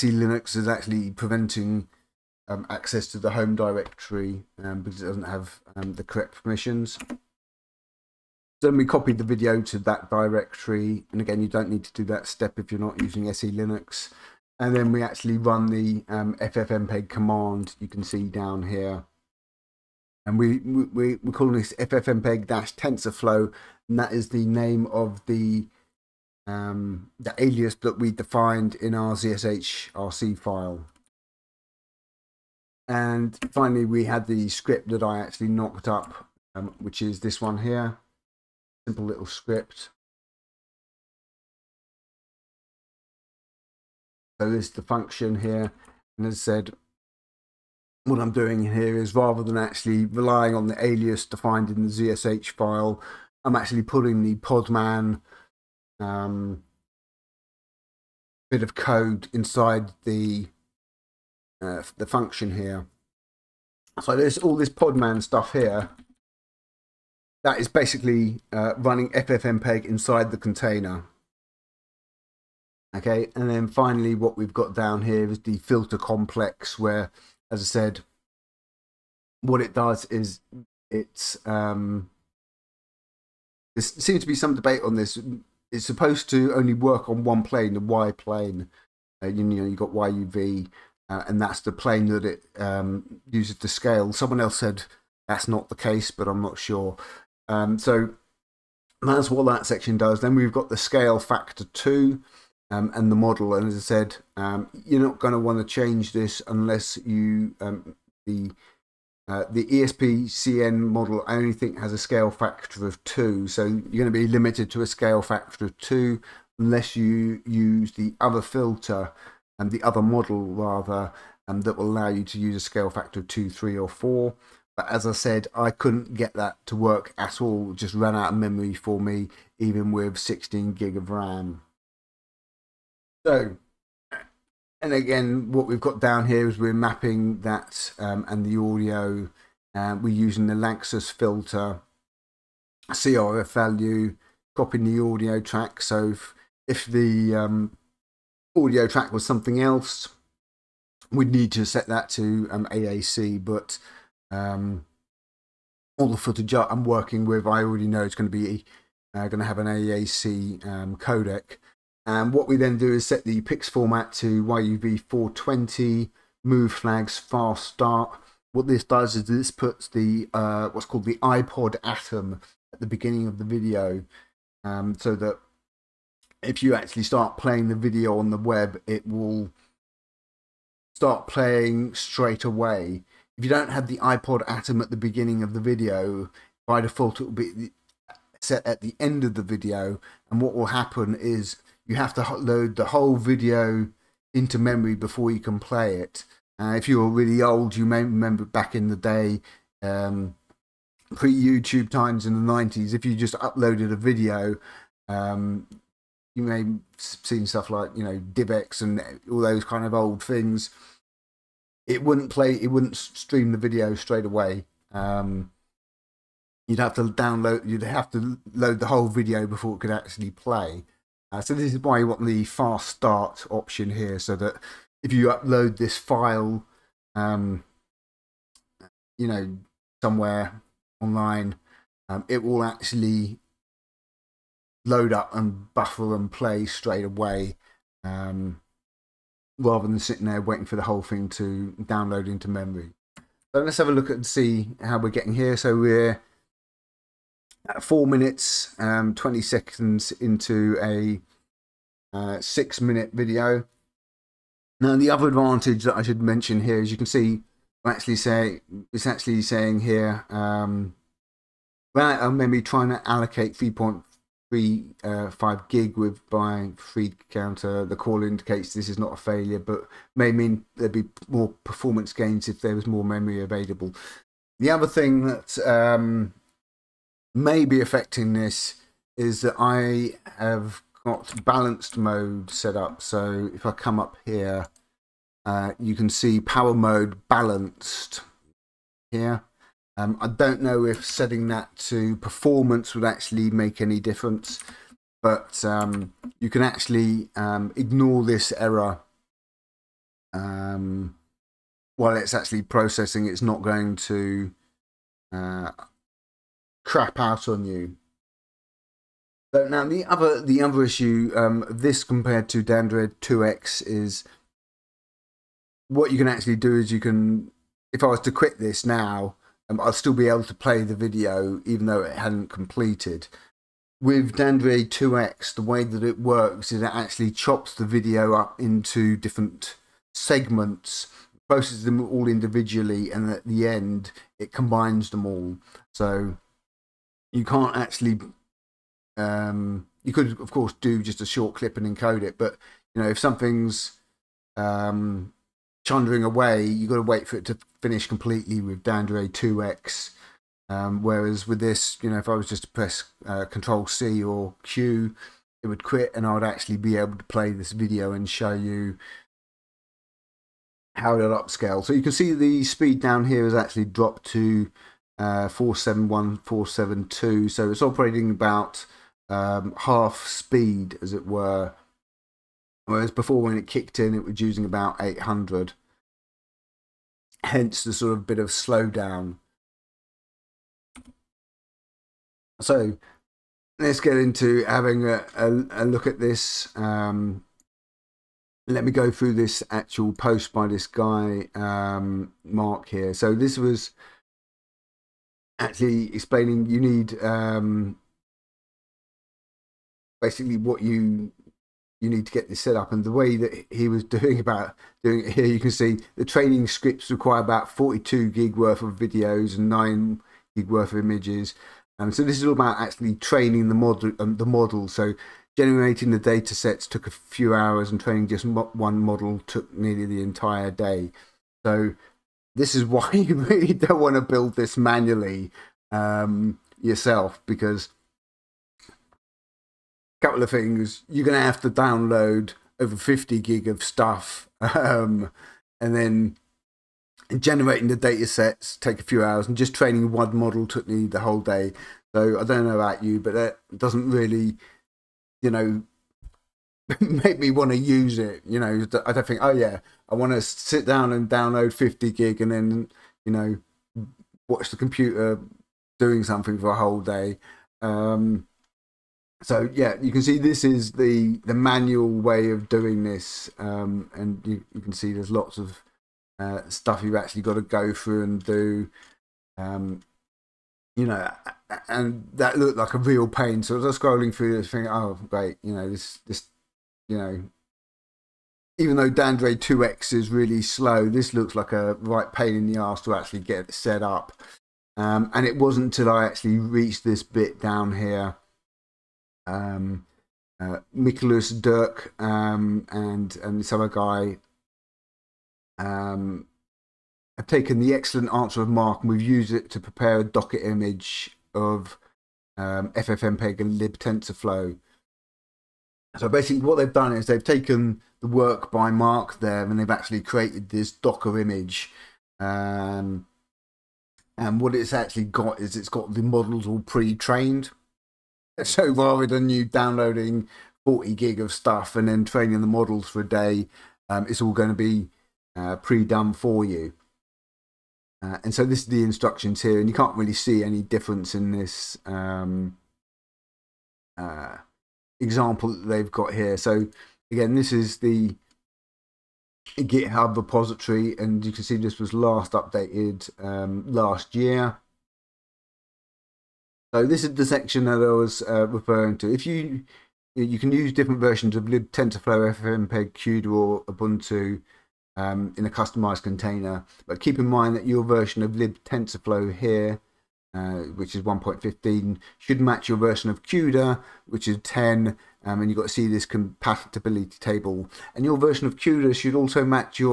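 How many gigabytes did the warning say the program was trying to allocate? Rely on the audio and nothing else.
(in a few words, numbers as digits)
3.35.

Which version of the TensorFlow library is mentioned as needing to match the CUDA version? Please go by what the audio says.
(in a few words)
1.15.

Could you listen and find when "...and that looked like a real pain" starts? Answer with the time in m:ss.
7:51.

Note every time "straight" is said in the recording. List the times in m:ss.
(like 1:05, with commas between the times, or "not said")
3:01, 3:33, 3:56.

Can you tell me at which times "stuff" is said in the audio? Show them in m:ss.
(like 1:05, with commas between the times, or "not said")
1:05, 3:27, 7:13, 7:46, 8:41.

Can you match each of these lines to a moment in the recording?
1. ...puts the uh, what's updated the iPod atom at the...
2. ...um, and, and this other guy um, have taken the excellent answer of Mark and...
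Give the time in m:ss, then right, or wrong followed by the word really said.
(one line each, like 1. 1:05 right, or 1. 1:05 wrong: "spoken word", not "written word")
1. 2:49 wrong: "called", not "updated"
2. 8:12 right.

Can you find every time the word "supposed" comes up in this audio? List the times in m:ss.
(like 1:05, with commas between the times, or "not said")
1:25.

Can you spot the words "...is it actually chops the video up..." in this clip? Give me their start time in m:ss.
5:26.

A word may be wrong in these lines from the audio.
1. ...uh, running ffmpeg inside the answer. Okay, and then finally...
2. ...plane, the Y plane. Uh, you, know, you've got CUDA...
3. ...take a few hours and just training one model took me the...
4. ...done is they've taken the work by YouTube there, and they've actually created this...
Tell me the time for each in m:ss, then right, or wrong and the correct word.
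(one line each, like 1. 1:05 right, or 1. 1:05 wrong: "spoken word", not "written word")
1. 1:08 wrong: "container", not "answer"
2. 1:27 wrong: "YUV", not "CUDA"
3. 7:18 right
4. 8:26 wrong: "Mark", not "YouTube".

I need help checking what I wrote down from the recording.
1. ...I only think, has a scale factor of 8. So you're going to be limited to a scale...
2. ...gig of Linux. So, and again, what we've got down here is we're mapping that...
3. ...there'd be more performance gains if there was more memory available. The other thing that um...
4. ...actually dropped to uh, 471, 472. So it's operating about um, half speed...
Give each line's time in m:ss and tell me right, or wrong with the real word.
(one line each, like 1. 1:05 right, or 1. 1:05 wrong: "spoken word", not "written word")
1. 1:51 wrong: "2", not "8"
2. 2:10 wrong: "RAM", not "Linux"
3. 4:30 right
4. 6:03 right.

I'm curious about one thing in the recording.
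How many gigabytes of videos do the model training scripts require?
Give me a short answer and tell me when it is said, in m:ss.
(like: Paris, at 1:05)
42 GB, at 6:47.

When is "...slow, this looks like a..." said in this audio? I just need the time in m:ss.
8:00.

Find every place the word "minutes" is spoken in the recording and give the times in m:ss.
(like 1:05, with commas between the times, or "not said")
4:08, 4:12.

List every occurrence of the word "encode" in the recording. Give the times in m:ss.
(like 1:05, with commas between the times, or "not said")
5:41.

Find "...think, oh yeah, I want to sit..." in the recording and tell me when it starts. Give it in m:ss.
7:29.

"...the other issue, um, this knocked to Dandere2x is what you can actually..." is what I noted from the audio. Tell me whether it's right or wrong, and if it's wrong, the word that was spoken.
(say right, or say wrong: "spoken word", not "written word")
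wrong: "compared", not "knocked".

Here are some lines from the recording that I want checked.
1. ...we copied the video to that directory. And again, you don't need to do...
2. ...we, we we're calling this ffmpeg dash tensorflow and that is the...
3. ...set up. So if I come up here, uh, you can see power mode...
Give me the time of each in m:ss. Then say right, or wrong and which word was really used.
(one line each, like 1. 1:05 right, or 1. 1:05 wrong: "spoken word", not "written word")
1. 0:08 right
2. 0:20 right
3. 4:42 right.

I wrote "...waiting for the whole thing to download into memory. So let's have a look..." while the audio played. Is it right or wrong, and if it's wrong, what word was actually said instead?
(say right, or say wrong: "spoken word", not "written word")
right.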